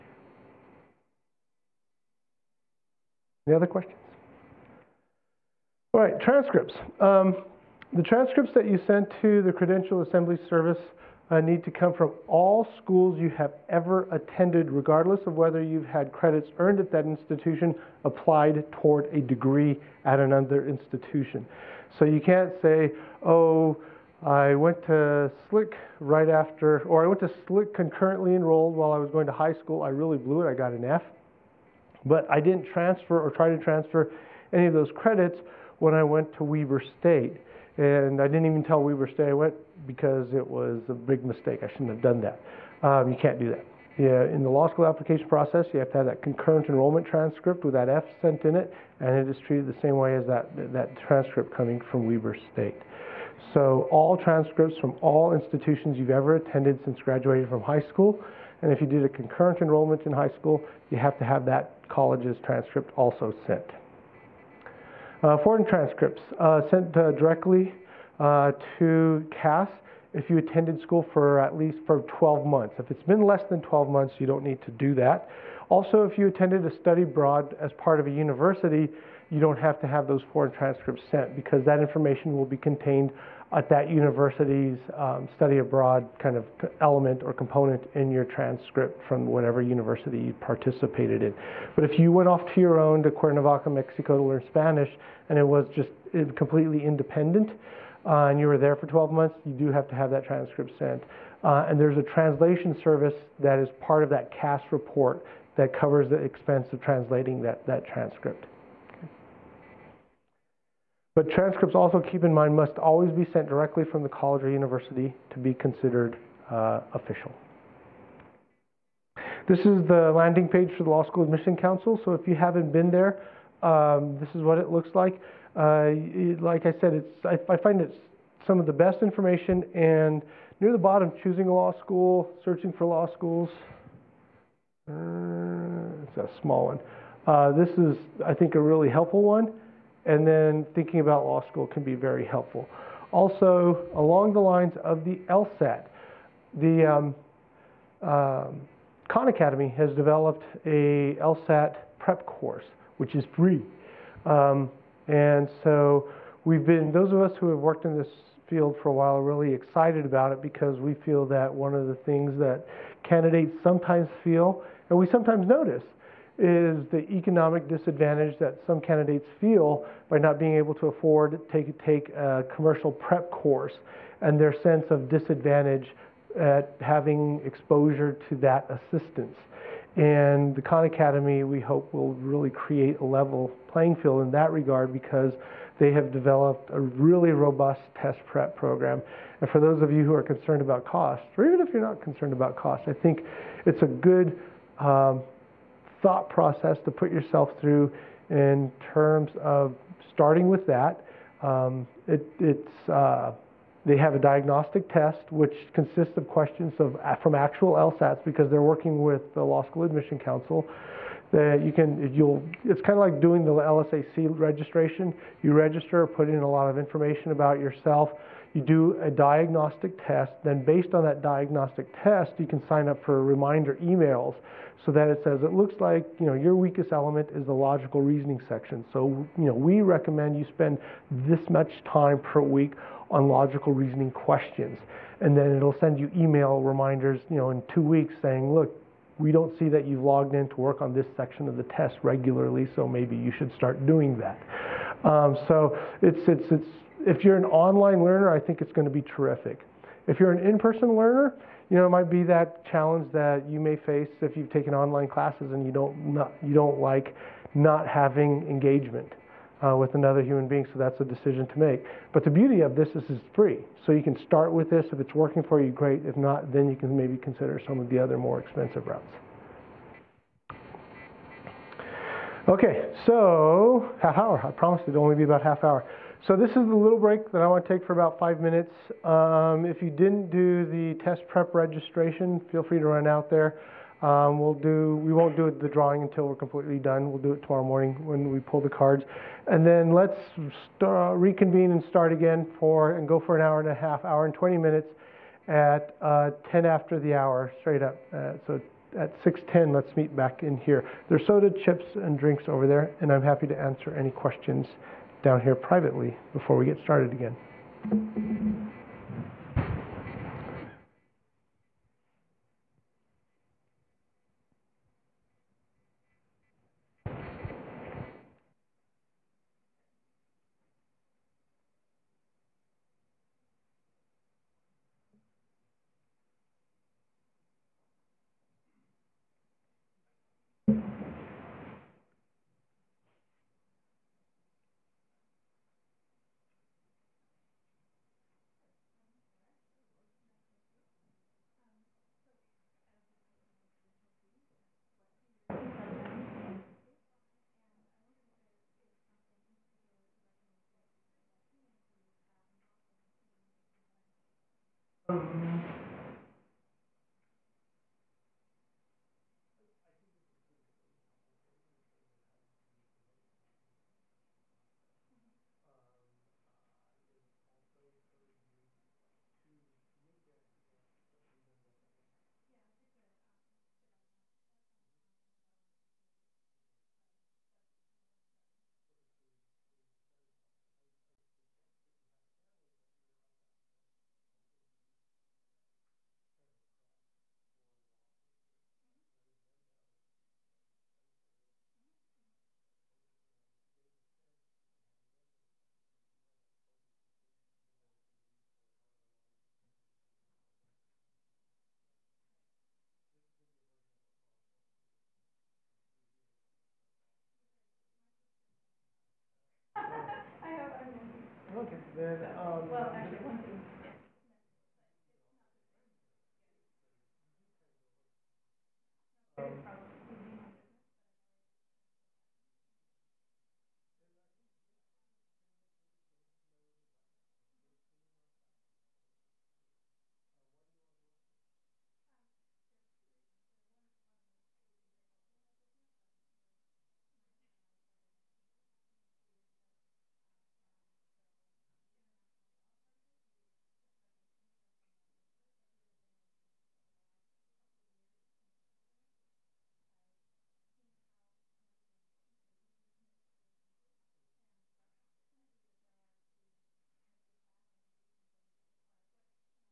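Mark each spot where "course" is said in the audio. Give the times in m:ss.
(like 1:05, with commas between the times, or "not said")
2:32, 2:53.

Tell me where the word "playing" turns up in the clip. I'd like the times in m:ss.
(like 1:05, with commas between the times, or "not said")
3:03.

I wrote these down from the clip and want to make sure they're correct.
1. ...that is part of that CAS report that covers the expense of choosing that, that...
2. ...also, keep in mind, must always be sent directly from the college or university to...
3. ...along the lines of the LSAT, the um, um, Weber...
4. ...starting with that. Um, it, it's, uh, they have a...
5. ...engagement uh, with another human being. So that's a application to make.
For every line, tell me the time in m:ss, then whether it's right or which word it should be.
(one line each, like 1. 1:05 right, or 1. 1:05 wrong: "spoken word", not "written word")
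1. 1:43 wrong: "translating", not "choosing"
2. 1:51 right
3. 2:23 wrong: "Khan", not "Weber"
4. 3:20 right
5. 4:18 wrong: "decision", not "application".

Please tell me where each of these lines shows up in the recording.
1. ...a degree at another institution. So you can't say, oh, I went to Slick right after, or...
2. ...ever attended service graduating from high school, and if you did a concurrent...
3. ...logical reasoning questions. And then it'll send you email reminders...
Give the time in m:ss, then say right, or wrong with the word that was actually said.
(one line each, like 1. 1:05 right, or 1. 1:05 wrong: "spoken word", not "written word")
1. 0:19 right
2. 0:56 wrong: "since", not "service"
3. 3:53 right.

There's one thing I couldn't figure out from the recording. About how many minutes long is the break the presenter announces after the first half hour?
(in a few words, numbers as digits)
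5 minutes.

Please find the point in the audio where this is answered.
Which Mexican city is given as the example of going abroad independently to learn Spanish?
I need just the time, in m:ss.
1:33.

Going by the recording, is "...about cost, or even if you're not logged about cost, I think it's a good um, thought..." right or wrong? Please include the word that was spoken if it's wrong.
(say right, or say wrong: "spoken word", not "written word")
wrong: "concerned", not "logged".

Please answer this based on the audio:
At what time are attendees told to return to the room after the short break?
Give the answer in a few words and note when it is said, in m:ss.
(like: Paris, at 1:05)
6:10, at 4:59.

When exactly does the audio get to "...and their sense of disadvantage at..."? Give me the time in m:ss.
2:54.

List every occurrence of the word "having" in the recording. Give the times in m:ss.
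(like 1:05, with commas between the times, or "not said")
2:56, 4:17.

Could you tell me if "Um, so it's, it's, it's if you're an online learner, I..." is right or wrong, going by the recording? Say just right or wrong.
right.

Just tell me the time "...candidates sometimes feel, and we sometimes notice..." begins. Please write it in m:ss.
2:43.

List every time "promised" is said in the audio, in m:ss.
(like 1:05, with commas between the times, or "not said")
4:34.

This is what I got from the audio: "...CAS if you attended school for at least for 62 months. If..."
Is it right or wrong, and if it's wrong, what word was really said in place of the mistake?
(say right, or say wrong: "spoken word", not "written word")
wrong: "12", not "62".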